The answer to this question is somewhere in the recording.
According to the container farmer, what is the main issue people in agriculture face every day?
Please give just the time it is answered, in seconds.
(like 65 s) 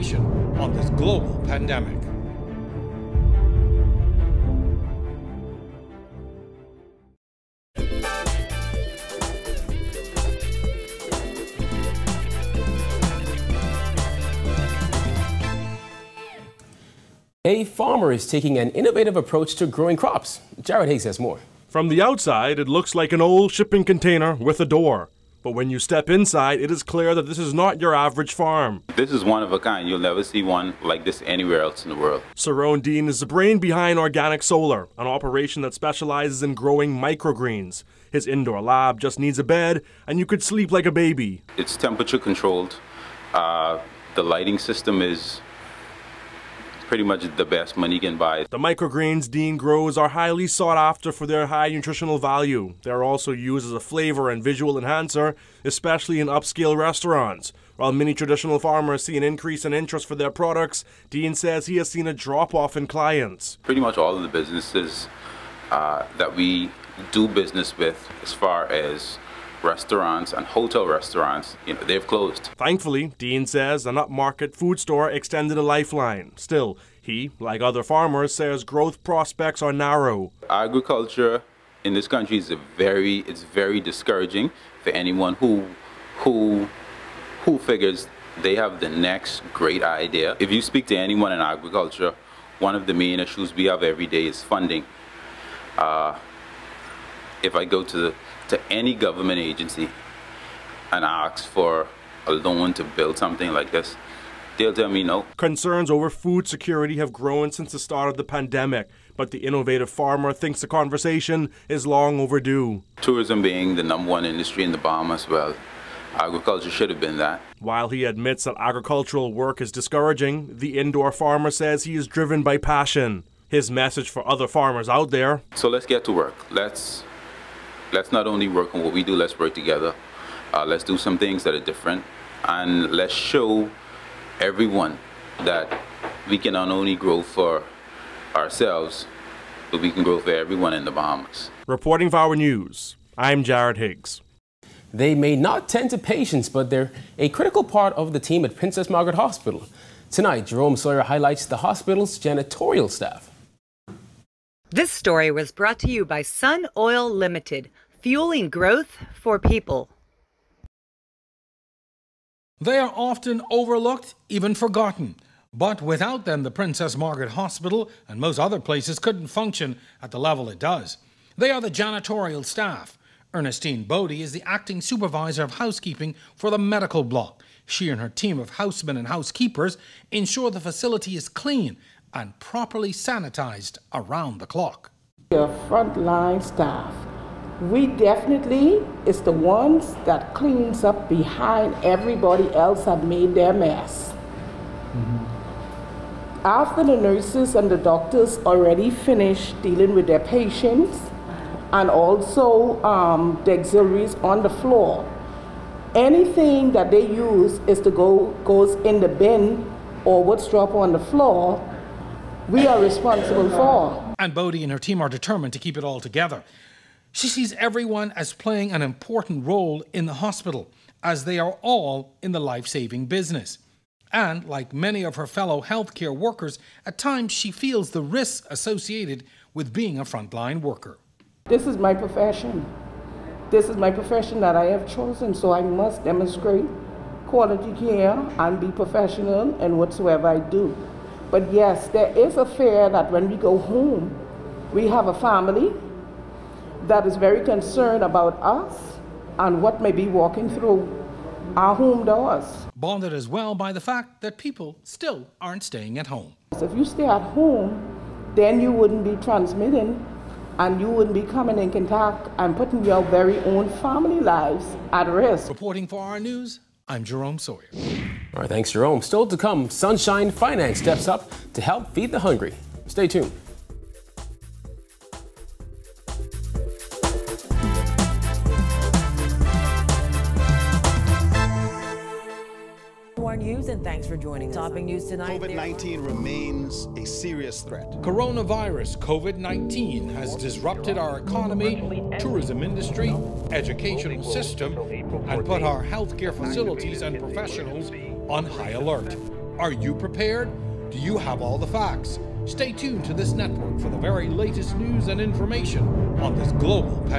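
94 s.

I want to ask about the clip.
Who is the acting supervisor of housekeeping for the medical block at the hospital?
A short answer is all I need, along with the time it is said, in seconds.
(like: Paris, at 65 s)
Ernestine Bodie, at 173 s.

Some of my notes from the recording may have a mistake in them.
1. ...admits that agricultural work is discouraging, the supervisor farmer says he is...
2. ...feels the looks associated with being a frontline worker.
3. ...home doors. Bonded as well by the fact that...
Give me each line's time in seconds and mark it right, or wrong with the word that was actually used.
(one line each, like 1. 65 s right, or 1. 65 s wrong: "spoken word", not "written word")
1. 118 s wrong: "indoor", not "supervisor"
2. 227 s wrong: "risks", not "looks"
3. 251 s right.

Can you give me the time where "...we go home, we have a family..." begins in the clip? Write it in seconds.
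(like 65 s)
243 s.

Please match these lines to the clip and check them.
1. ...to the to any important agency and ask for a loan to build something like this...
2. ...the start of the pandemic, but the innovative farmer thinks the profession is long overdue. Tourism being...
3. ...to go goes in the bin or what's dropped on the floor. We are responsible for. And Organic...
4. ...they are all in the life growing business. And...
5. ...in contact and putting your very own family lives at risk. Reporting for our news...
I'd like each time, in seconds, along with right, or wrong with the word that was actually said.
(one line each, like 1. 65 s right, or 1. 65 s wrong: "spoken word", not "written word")
1. 97 s wrong: "government", not "important"
2. 107 s wrong: "conversation", not "profession"
3. 207 s wrong: "Bodie", not "Organic"
4. 221 s wrong: "saving", not "growing"
5. 261 s right.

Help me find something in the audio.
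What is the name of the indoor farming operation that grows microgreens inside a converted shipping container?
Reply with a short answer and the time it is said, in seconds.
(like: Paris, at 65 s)
Organic Solar, at 33 s.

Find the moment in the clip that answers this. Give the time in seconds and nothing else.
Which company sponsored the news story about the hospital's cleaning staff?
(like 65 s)
156 s.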